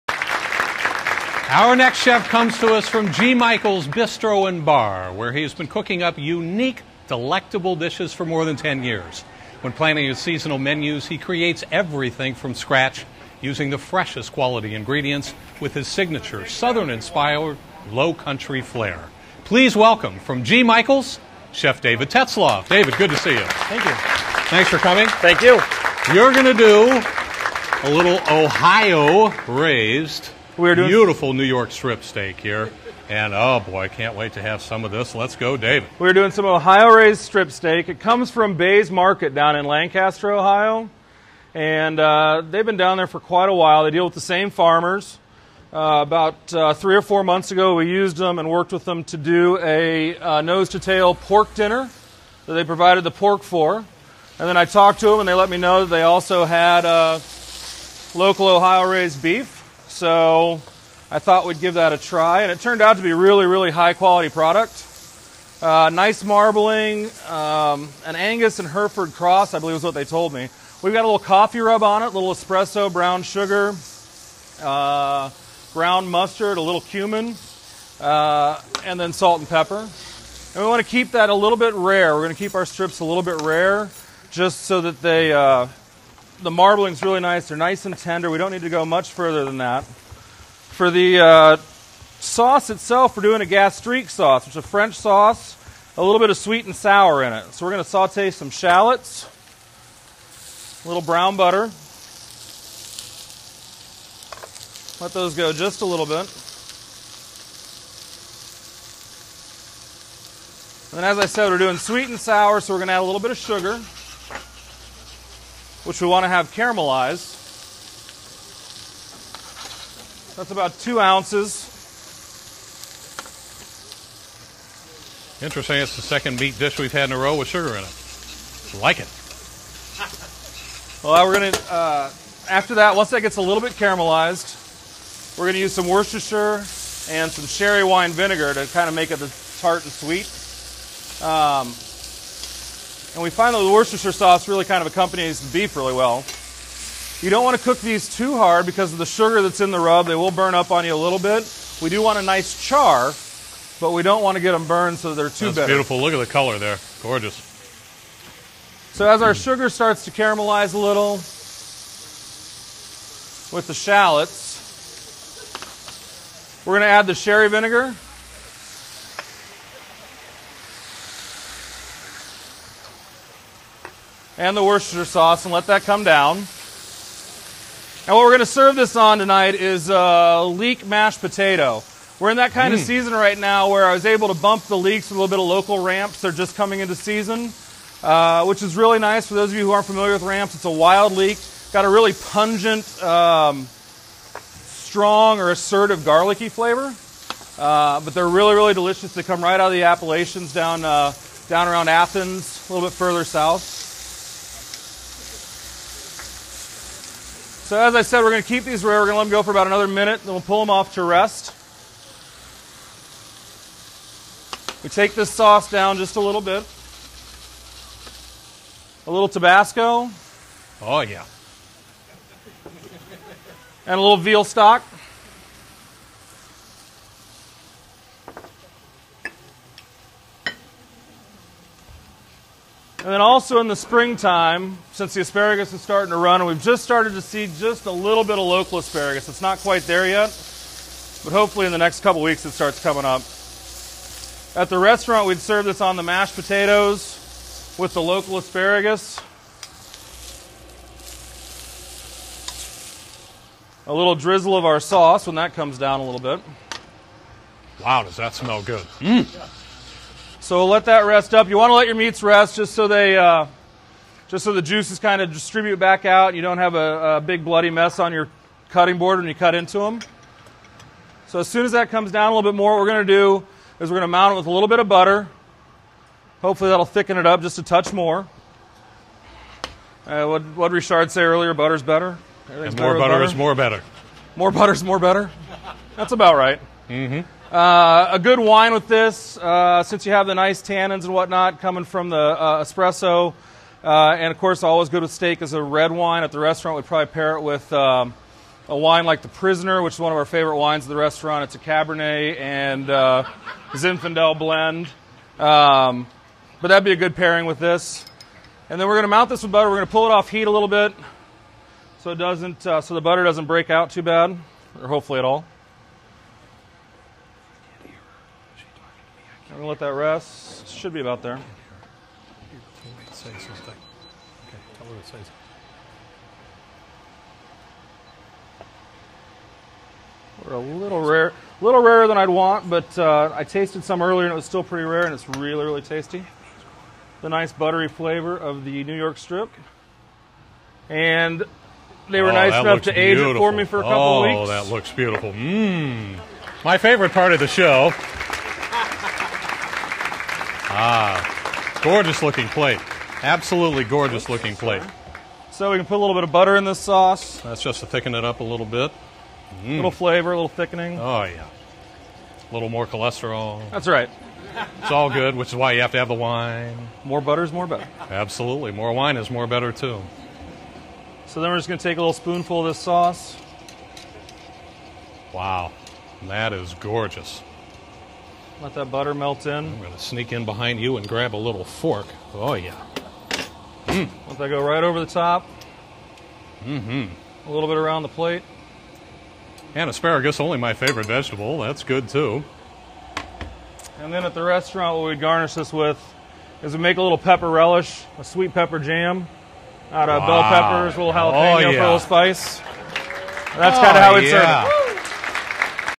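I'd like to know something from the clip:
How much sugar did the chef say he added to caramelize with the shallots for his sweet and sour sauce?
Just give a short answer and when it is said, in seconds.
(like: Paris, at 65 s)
2 ounces, at 120 s.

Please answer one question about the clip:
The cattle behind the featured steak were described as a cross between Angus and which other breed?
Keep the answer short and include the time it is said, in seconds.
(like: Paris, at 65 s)
Hereford, at 68 s.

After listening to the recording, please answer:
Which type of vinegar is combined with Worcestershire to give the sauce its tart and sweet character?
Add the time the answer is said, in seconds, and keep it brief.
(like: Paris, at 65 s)
sherry wine vinegar, at 137 s.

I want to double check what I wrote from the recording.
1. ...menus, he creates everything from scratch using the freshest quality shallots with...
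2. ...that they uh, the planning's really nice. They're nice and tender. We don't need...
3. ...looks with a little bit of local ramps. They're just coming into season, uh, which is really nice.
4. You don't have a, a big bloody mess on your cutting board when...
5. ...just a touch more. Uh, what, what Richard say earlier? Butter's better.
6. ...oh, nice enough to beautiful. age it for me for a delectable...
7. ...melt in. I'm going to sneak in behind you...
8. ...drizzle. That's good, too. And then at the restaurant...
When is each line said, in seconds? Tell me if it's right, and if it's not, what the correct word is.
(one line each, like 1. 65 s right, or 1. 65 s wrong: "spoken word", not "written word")
1. 10 s wrong: "ingredients", not "shallots"
2. 84 s wrong: "marbling", not "planning"
3. 184 s wrong: "leeks", not "looks"
4. 266 s right
5. 277 s right
6. 342 s wrong: "couple", not "delectable"
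7. 379 s right
8. 391 s wrong: "vegetable", not "drizzle".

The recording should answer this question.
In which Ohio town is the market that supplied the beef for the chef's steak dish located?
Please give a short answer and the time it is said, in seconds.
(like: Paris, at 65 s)
Lancaster, Ohio, at 39 s.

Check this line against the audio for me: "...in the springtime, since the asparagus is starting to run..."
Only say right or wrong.
right.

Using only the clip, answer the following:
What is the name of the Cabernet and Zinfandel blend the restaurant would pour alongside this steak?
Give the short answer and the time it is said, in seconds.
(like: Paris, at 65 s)
The Prisoner, at 299 s.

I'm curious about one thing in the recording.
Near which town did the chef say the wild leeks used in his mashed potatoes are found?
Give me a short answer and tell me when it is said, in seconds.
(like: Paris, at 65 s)
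Athens, at 201 s.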